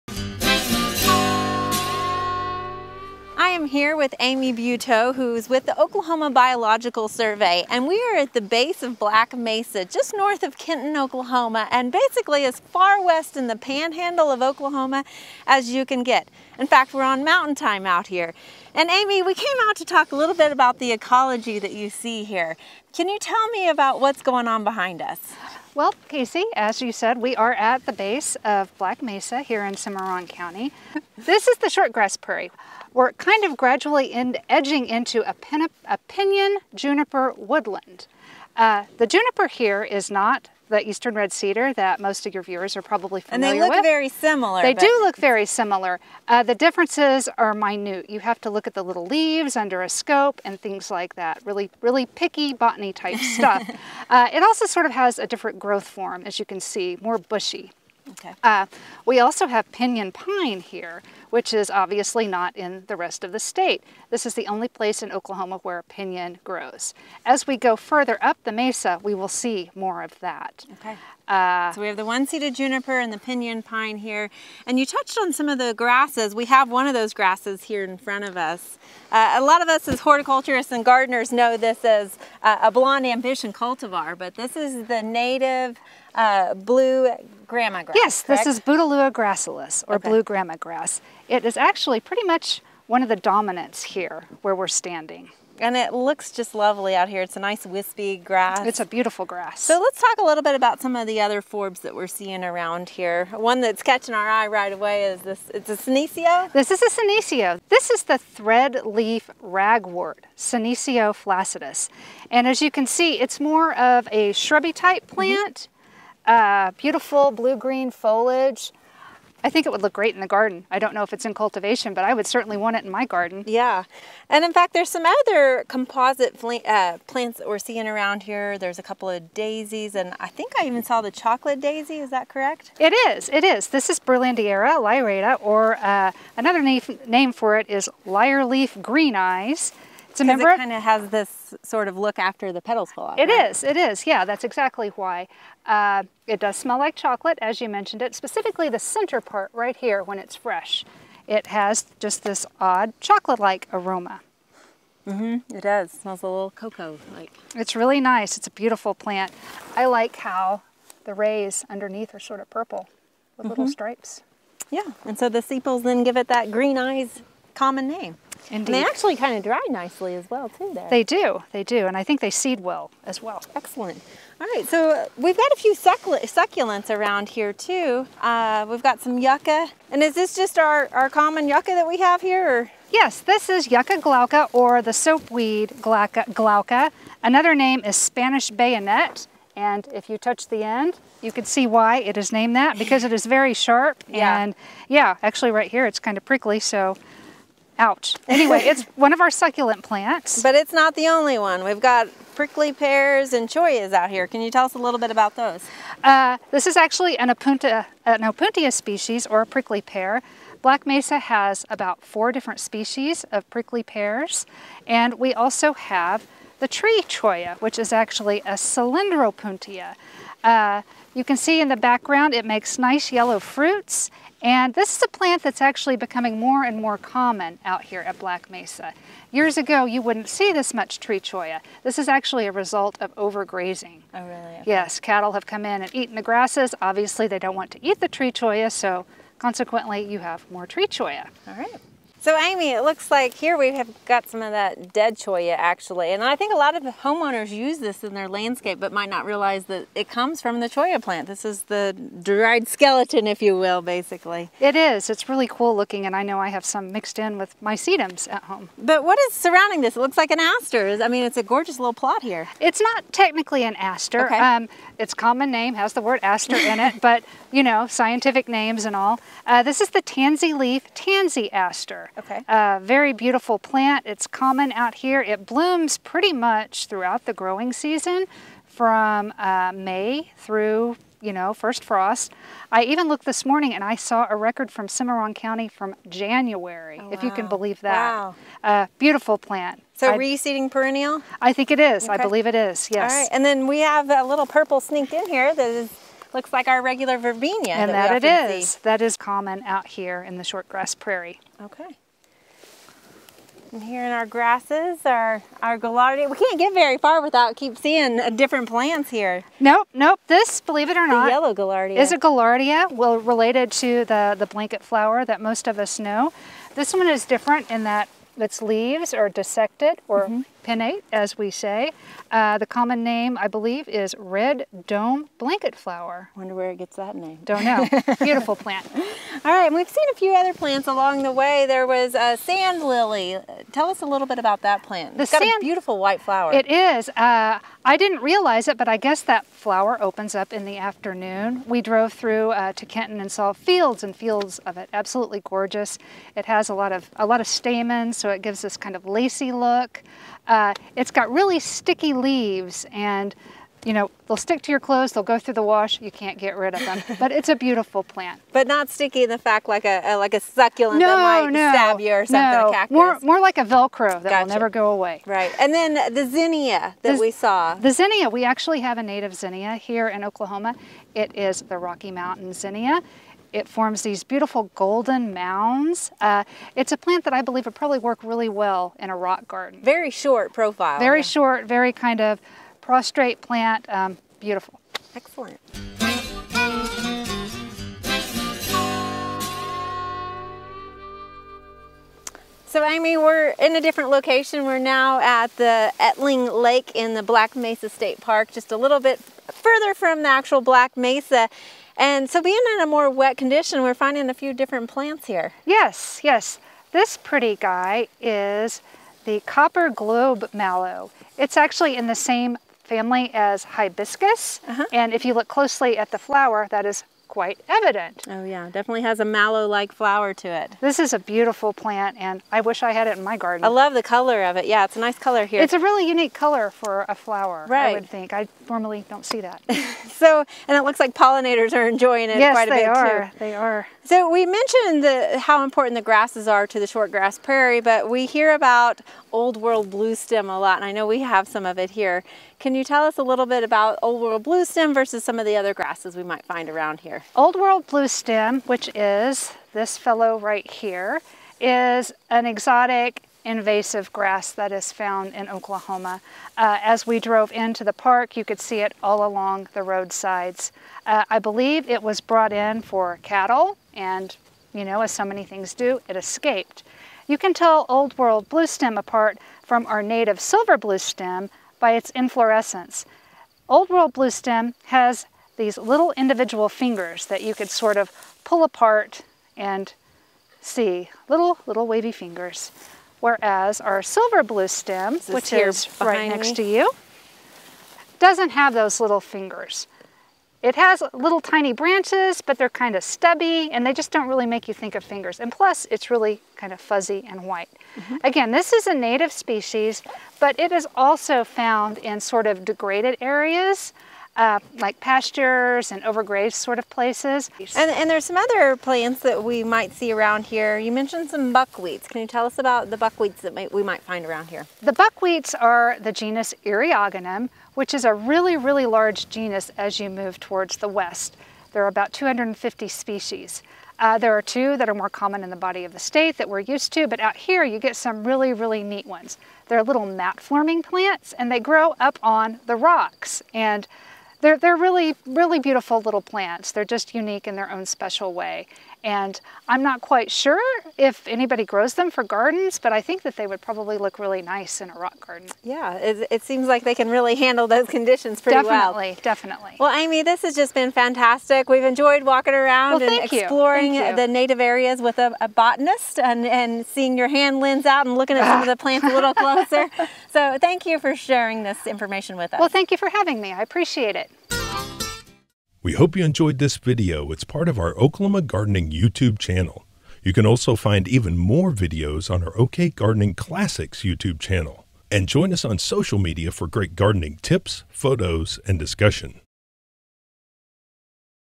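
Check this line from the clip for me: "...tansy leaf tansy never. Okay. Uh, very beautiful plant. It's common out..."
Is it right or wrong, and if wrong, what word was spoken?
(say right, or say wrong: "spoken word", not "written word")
wrong: "aster", not "never".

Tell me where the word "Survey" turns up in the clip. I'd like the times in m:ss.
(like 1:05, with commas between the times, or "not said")
0:07.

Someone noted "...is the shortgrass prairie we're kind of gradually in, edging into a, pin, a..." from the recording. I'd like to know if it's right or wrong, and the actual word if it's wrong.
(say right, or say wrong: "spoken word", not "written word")
right.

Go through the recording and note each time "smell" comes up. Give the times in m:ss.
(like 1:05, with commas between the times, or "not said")
2:26, 2:36.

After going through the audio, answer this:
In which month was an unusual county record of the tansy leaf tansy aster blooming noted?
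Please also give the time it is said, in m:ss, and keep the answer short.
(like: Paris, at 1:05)
January, at 4:46.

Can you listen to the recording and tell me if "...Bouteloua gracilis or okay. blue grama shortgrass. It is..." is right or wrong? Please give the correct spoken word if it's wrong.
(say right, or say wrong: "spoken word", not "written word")
wrong: "grass", not "shortgrass".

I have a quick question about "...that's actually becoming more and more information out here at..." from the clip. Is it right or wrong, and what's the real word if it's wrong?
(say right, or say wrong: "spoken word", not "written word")
wrong: "common", not "information".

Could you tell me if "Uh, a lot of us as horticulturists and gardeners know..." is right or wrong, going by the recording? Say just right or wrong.
right.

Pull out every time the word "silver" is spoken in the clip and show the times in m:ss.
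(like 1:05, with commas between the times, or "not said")
7:50, 8:04.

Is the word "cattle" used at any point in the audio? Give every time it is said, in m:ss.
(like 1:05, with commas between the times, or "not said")
3:54, 7:43.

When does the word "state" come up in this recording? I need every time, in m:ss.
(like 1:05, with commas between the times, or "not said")
1:03, 6:37, 8:45.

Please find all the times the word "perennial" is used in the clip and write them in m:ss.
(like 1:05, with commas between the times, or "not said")
4:50.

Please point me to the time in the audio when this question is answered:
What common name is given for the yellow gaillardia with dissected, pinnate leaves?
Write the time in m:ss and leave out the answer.
5:24.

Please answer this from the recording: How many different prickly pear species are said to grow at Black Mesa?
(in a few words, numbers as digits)
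4.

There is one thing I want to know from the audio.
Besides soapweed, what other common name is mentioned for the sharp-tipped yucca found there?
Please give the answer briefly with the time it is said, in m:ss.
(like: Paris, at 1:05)
Spanish bayonet, at 3:07.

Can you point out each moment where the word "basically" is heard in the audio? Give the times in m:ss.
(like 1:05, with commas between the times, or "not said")
0:11, 4:13.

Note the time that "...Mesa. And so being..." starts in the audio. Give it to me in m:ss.
6:40.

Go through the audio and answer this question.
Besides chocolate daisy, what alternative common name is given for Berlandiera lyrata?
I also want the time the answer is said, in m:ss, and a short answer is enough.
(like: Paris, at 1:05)
lyre leaf green eyes, at 2:18.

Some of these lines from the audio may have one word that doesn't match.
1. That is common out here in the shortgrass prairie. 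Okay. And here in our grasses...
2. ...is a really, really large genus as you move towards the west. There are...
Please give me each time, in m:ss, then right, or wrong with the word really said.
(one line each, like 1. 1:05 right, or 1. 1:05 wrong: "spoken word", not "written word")
1. 4:58 right
2. 8:37 right.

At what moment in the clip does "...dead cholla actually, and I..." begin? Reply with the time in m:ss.
4:04.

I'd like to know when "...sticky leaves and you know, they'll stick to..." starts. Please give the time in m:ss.
5:51.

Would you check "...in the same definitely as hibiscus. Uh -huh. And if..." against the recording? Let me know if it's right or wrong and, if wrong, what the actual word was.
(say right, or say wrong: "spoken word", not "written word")
wrong: "family", not "definitely".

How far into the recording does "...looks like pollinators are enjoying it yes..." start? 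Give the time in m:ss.
7:10.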